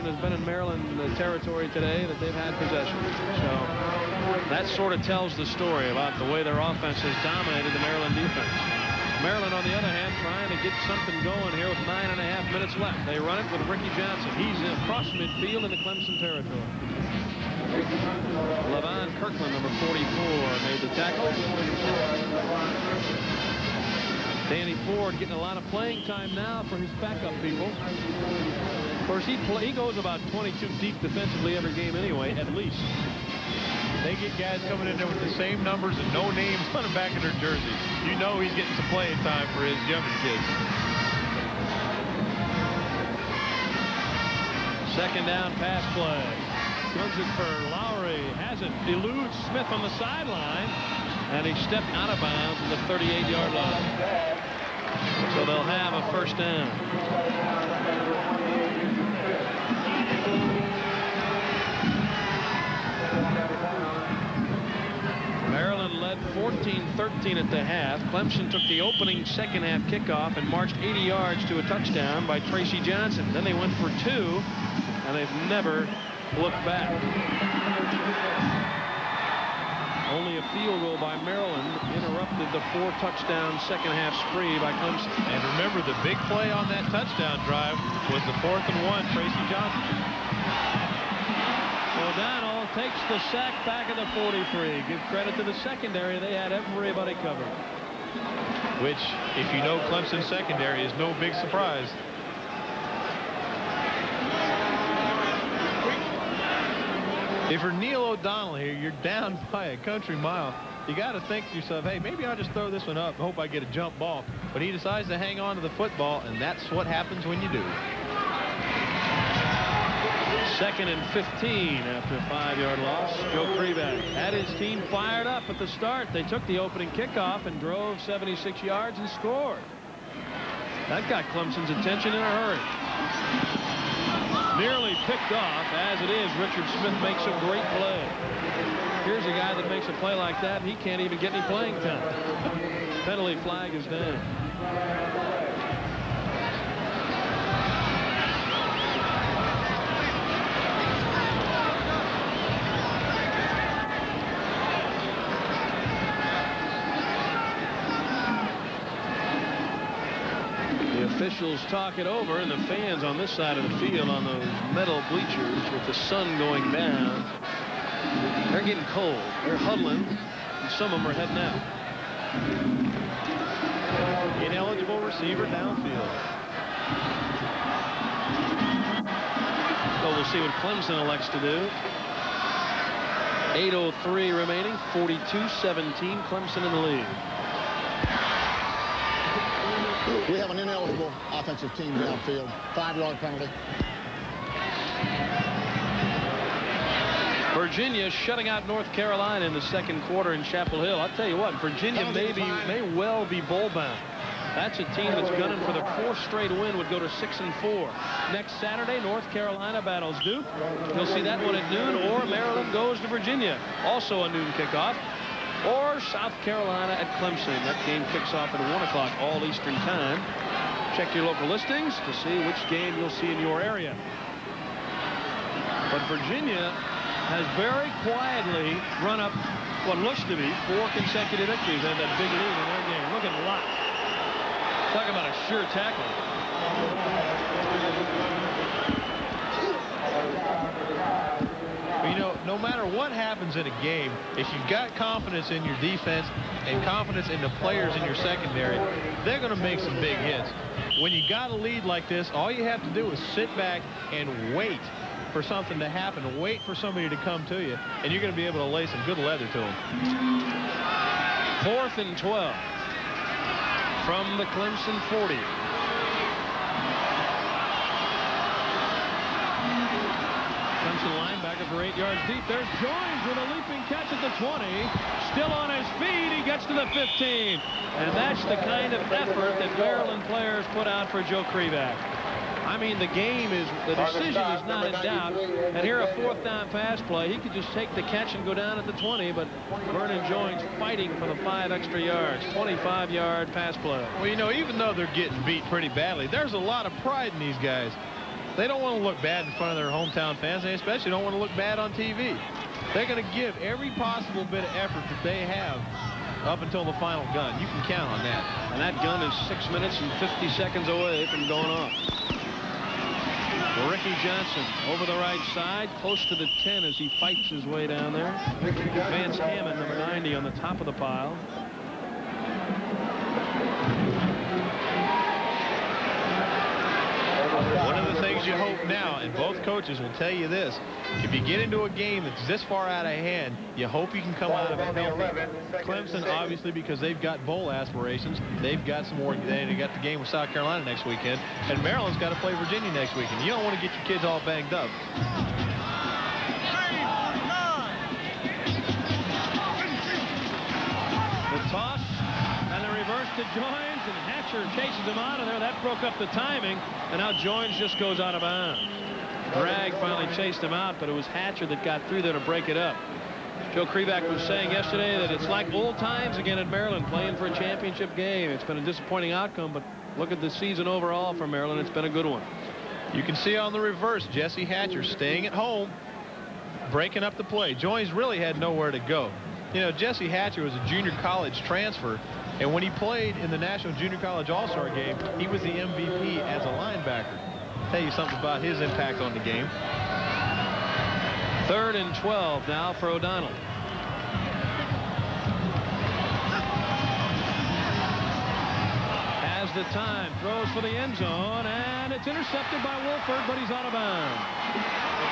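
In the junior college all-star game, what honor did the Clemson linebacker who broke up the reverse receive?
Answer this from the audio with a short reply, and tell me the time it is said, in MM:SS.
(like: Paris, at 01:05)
MVP, at 06:25.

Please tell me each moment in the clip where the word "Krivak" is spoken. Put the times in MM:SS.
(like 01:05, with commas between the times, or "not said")
02:03, 04:41, 06:03.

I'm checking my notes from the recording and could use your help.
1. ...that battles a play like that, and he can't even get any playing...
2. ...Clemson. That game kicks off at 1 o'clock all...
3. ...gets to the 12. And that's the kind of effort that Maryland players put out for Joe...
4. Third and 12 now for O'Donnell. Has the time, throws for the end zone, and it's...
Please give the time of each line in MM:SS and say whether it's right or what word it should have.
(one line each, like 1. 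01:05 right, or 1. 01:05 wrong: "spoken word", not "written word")
1. 02:19 wrong: "makes", not "battles"
2. 03:37 right
3. 04:36 wrong: "15", not "12"
4. 06:31 right.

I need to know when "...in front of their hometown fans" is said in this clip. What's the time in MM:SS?
04:59.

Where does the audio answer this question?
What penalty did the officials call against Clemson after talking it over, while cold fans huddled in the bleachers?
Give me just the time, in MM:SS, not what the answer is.
02:54.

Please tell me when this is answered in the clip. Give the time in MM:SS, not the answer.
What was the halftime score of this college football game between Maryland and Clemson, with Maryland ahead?
01:06.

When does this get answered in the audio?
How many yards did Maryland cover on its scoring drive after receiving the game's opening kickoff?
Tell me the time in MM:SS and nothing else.
02:08.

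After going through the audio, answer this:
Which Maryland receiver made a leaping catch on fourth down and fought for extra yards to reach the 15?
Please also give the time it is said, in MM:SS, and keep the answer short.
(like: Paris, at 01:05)
Vernon Joines, at 04:49.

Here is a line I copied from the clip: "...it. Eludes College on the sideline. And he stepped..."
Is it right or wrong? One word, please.
wrong.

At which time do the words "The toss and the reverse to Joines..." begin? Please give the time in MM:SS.
05:51.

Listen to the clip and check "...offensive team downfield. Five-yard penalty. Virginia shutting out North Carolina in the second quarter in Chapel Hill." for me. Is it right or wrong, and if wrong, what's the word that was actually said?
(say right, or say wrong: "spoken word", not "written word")
right.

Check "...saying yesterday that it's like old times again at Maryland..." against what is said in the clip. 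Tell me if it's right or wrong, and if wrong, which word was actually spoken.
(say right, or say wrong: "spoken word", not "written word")
right.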